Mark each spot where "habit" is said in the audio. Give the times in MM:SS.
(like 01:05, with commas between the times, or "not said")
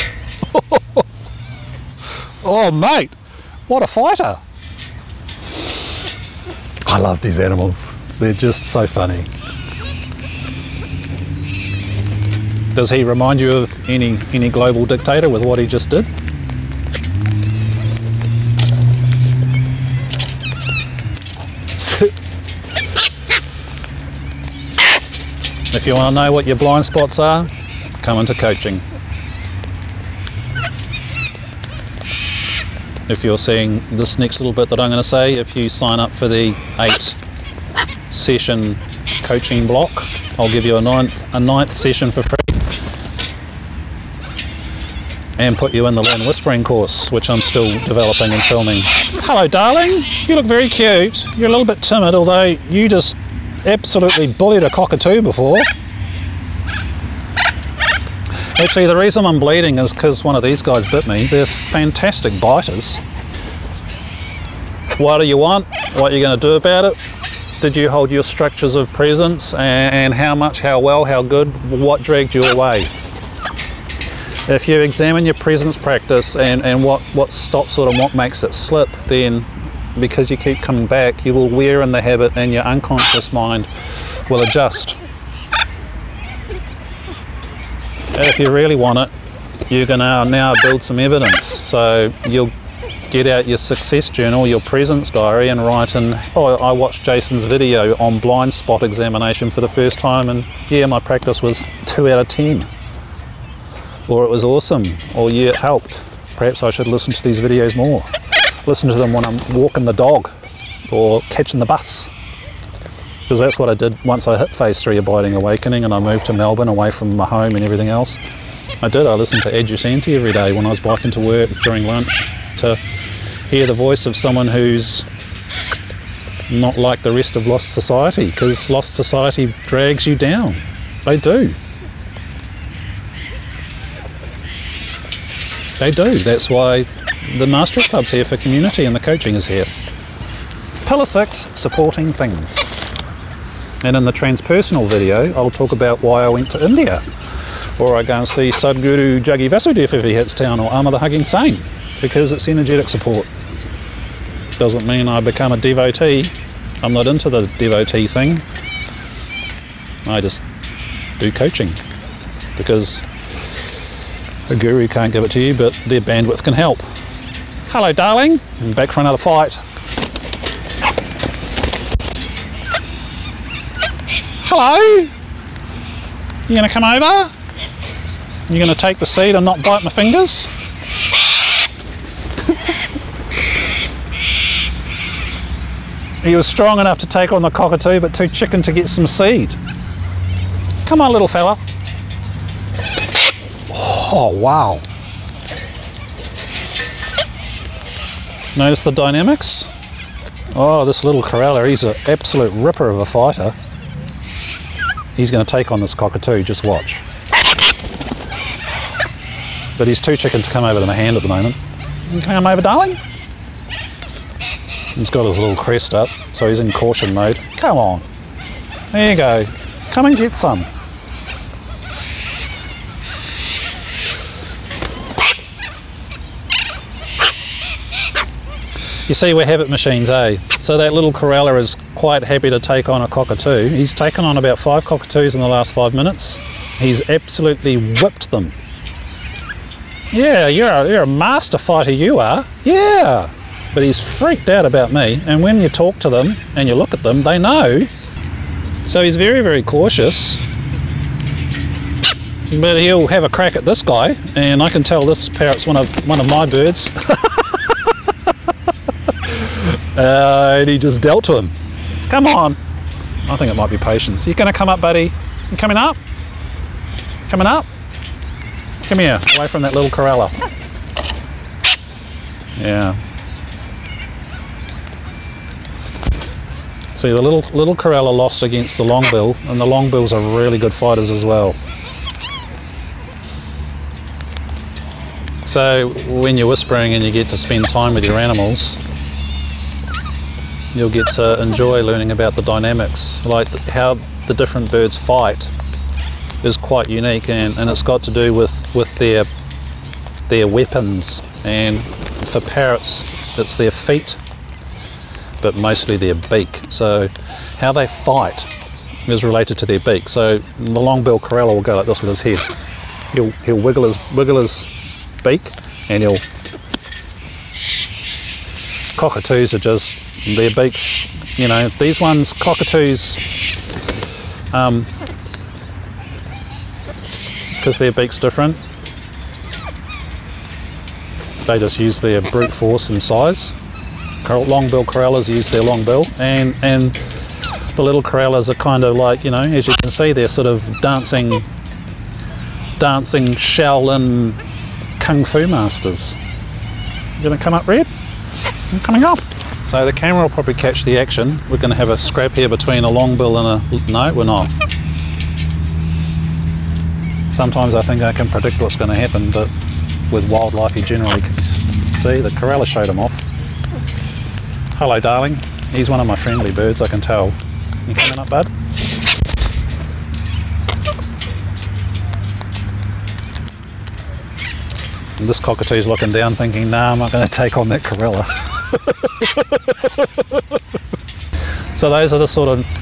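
01:22.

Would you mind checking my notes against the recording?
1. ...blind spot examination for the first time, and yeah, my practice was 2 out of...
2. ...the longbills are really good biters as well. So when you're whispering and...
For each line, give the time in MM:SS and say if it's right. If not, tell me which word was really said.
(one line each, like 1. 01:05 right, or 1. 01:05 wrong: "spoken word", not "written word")
1. 01:38 right
2. 04:39 wrong: "fighters", not "biters".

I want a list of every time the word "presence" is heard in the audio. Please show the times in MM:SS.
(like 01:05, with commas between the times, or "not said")
01:08, 01:15, 01:34.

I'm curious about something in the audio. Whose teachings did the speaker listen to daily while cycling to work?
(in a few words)
Adyashanti.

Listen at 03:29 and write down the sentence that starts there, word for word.
but he's too chicken to come over to my hand at the moment.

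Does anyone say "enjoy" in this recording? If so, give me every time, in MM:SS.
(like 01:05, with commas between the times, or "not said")
04:51.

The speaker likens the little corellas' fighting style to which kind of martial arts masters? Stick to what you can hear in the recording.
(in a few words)
Shaolin kung fu.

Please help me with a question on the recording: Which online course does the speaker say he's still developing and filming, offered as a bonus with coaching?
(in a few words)
Learn Whispering.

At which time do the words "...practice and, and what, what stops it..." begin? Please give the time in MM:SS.
01:15.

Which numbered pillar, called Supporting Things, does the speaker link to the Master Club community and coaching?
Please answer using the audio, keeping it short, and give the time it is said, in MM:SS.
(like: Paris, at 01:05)
6, at 02:20.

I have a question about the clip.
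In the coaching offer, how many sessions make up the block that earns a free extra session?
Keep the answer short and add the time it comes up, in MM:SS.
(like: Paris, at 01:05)
8, at 00:36.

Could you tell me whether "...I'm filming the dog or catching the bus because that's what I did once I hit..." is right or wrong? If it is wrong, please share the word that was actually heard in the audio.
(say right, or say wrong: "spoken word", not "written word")
wrong: "walking", not "filming".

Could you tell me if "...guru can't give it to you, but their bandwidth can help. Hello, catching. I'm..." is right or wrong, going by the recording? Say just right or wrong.
wrong.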